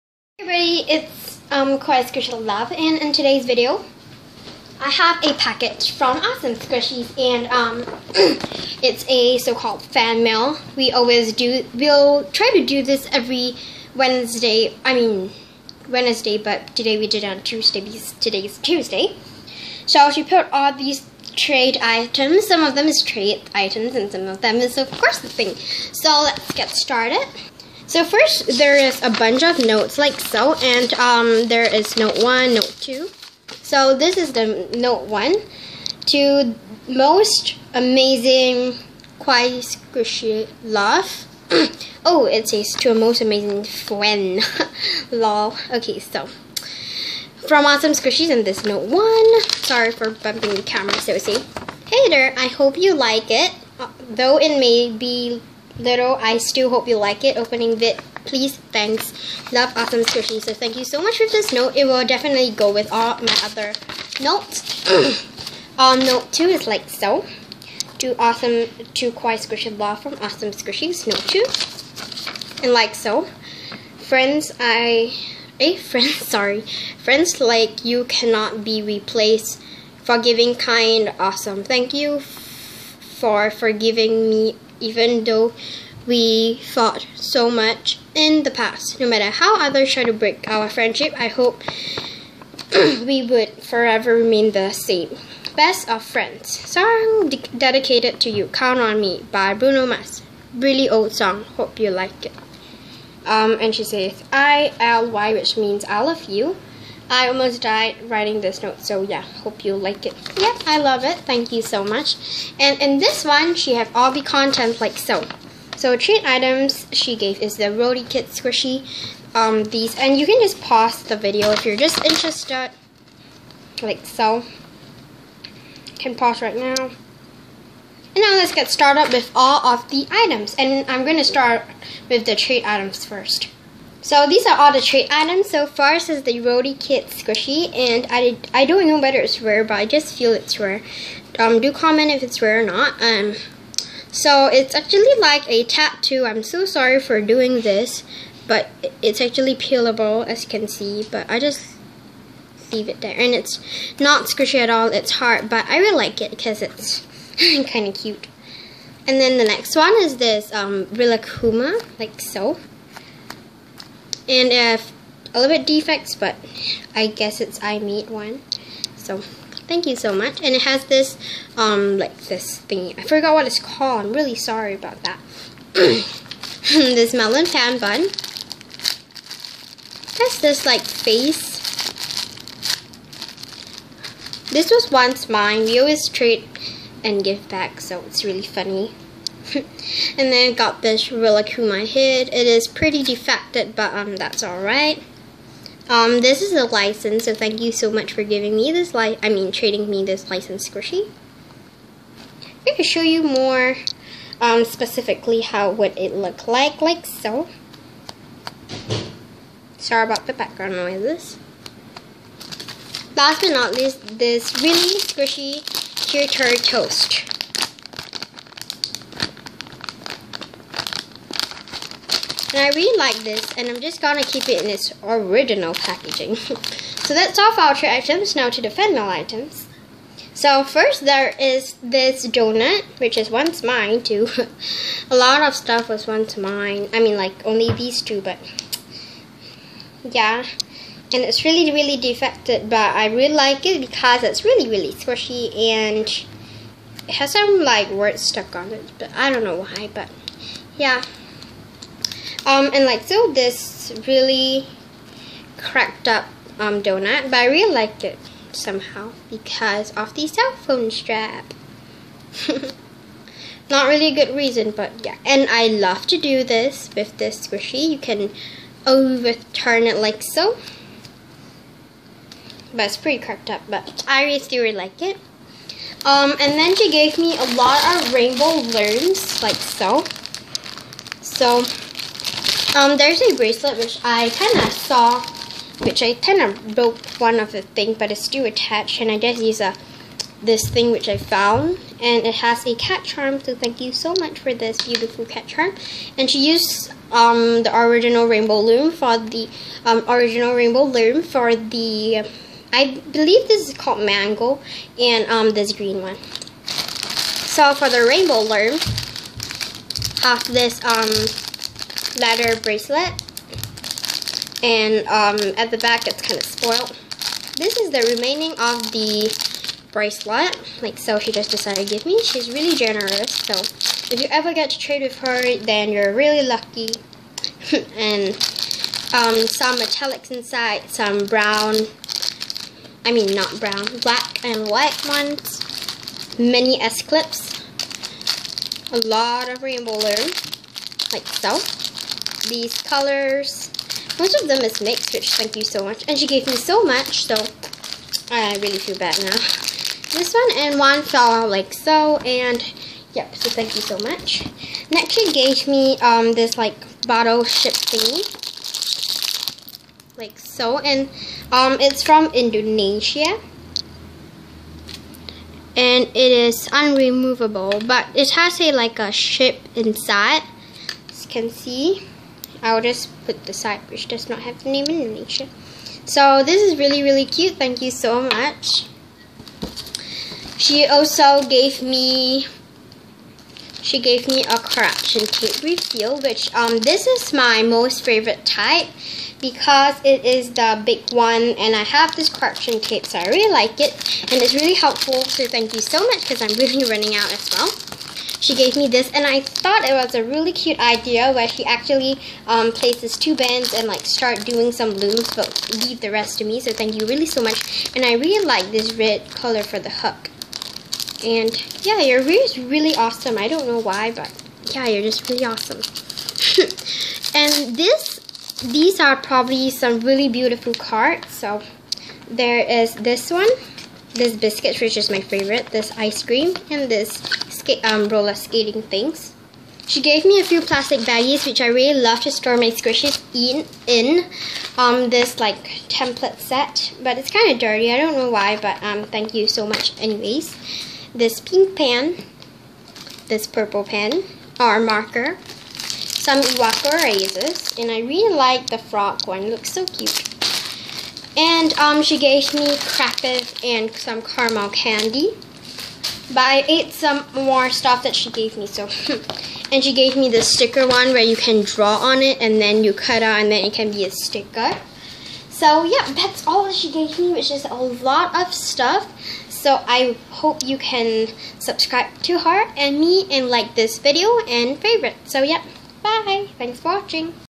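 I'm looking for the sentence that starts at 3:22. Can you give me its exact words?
I can show you more um, specifically how would it look like, like so.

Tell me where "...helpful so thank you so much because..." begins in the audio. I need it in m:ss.
6:34.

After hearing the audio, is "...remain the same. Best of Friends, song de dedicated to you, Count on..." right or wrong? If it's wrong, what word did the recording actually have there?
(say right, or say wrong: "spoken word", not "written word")
right.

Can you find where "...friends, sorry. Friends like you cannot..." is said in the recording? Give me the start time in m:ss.
1:15.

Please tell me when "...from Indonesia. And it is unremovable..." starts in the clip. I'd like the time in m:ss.
6:02.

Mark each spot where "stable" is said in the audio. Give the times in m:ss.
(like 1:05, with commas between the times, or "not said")
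not said.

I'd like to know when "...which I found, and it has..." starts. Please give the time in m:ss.
4:50.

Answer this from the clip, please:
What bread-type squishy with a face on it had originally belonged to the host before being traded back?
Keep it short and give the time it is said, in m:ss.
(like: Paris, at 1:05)
melon pan bun, at 2:57.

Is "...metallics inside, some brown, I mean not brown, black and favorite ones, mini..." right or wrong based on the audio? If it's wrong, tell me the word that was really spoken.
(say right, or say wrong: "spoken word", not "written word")
wrong: "white", not "favorite".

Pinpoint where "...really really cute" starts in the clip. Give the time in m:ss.
6:16.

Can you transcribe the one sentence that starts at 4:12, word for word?
Um, and like so, this really cracked up um, donut, but I really like it somehow because of the cell phone strap.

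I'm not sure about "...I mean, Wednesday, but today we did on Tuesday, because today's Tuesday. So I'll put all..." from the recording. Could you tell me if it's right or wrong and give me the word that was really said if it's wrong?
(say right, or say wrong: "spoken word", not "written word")
right.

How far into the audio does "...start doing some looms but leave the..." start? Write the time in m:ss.
6:44.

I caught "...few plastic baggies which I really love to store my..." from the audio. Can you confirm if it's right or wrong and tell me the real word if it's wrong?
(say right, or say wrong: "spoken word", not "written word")
right.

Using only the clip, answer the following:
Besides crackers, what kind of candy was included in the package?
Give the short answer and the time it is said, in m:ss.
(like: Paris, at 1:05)
caramel candy, at 7:34.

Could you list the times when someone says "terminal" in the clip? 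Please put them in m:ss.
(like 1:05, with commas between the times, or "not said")
not said.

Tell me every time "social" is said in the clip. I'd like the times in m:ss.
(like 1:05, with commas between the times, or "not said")
not said.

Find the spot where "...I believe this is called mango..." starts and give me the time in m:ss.
5:02.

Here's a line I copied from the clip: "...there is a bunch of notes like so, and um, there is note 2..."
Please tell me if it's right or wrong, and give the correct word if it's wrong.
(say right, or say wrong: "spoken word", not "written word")
wrong: "1", not "2".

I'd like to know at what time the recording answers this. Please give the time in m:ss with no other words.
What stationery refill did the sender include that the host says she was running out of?
6:24.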